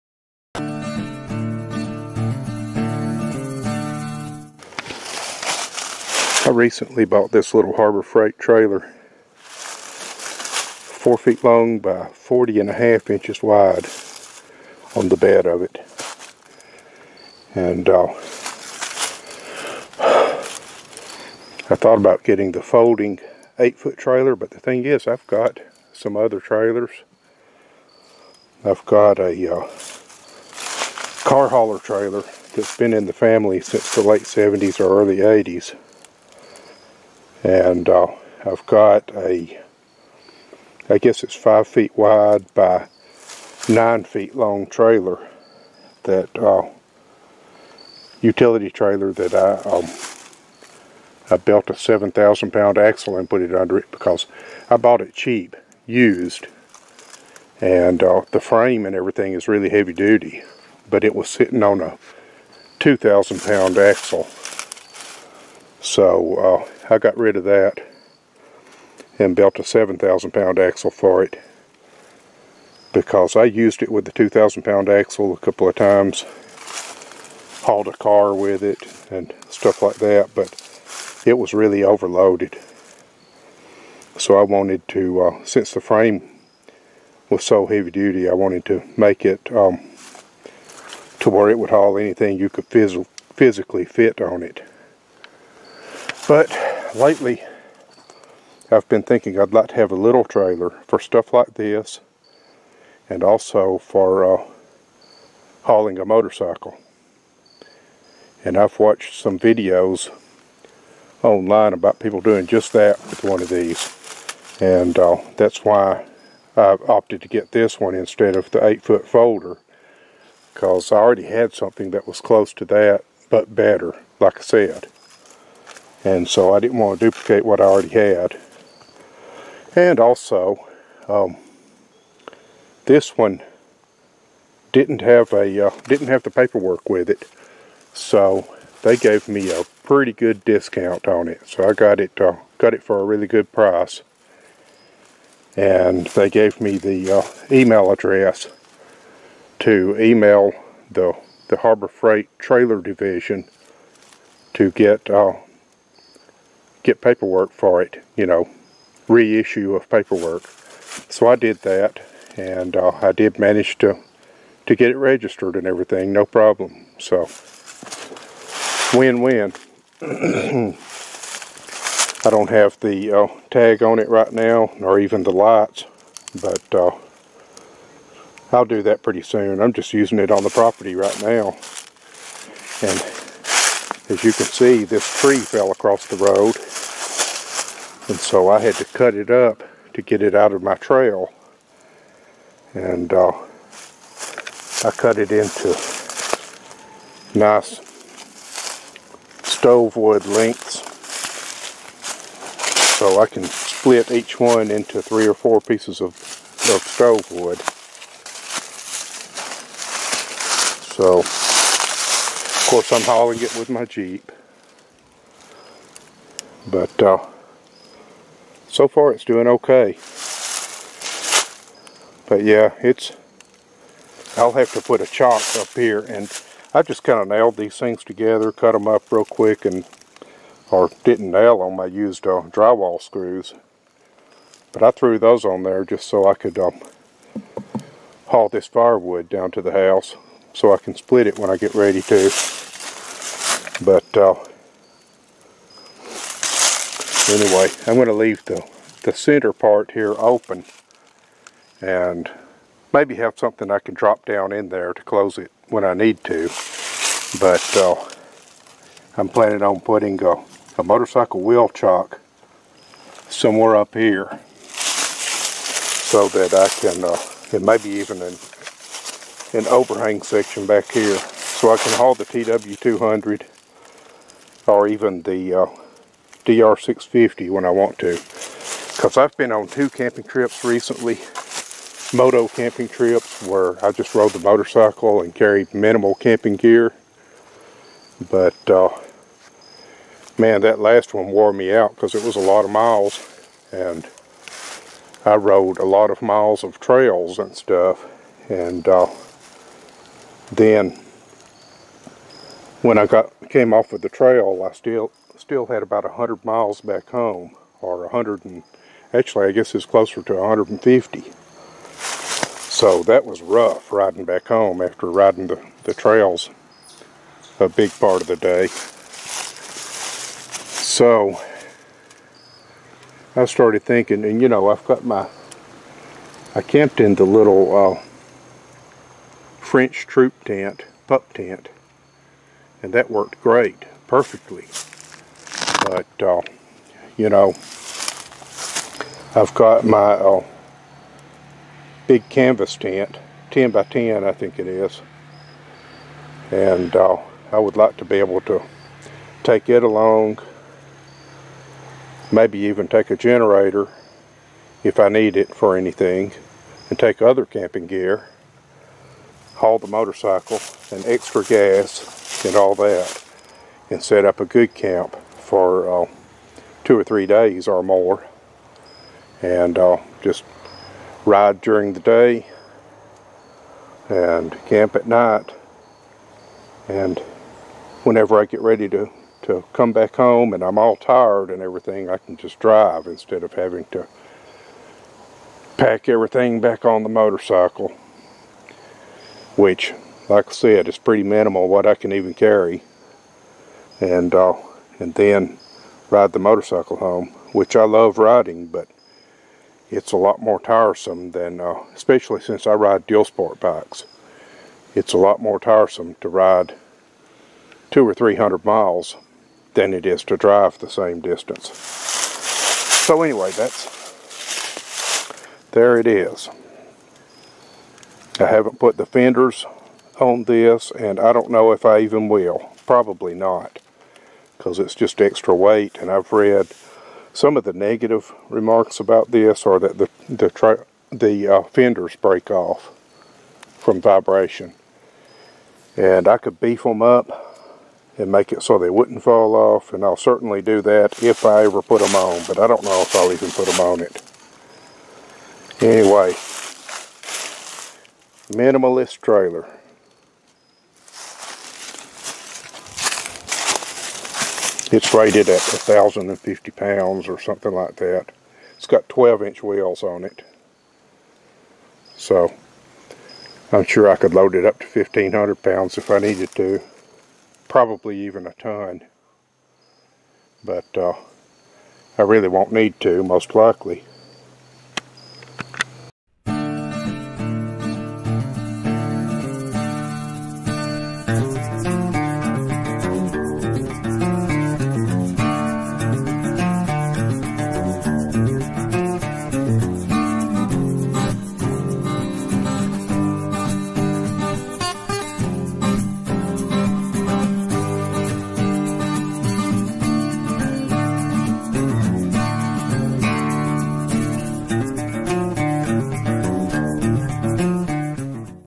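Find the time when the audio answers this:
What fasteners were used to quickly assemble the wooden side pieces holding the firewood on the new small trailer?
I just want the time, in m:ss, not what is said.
3:52.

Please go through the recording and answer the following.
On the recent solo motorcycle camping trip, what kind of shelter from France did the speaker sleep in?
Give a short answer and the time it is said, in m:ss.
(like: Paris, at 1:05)
French troop tent, at 5:29.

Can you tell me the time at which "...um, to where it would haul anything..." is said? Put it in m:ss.
1:29.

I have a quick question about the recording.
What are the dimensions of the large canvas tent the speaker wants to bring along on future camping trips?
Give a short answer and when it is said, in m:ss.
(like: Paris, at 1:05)
10 by 10, at 5:43.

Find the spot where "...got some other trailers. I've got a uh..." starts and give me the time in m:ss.
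0:25.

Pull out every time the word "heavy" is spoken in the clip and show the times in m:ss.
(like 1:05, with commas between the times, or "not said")
0:59, 1:27.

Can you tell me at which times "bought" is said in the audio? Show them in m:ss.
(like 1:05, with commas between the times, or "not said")
0:07, 0:54.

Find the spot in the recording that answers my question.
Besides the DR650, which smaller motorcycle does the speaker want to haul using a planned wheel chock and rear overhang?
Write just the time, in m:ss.
4:32.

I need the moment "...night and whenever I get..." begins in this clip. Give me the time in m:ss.
6:15.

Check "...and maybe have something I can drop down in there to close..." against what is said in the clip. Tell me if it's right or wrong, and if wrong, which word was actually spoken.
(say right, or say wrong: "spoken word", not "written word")
right.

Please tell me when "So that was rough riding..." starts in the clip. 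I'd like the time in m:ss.
5:12.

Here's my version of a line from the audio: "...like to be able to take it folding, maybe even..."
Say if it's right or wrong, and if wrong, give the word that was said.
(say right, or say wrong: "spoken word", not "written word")
wrong: "along", not "folding".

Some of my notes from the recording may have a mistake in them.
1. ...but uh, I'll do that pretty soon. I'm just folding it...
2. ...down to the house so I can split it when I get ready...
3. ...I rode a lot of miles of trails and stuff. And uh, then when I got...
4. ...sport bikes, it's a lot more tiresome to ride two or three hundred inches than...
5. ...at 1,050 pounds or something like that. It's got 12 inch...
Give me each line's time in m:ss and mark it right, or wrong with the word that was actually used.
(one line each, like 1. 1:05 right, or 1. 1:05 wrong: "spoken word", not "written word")
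1. 2:56 wrong: "using", not "folding"
2. 3:59 right
3. 4:55 right
4. 6:43 wrong: "miles", not "inches"
5. 7:35 right.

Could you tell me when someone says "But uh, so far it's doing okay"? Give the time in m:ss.
3:36.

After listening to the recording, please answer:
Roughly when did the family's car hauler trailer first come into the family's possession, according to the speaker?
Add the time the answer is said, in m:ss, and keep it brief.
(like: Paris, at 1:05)
late 70s, at 0:34.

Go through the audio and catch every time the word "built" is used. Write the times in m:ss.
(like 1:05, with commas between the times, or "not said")
0:51, 1:09.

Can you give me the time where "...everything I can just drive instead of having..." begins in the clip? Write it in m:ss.
6:21.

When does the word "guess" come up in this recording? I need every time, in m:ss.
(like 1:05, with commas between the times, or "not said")
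0:40, 5:09.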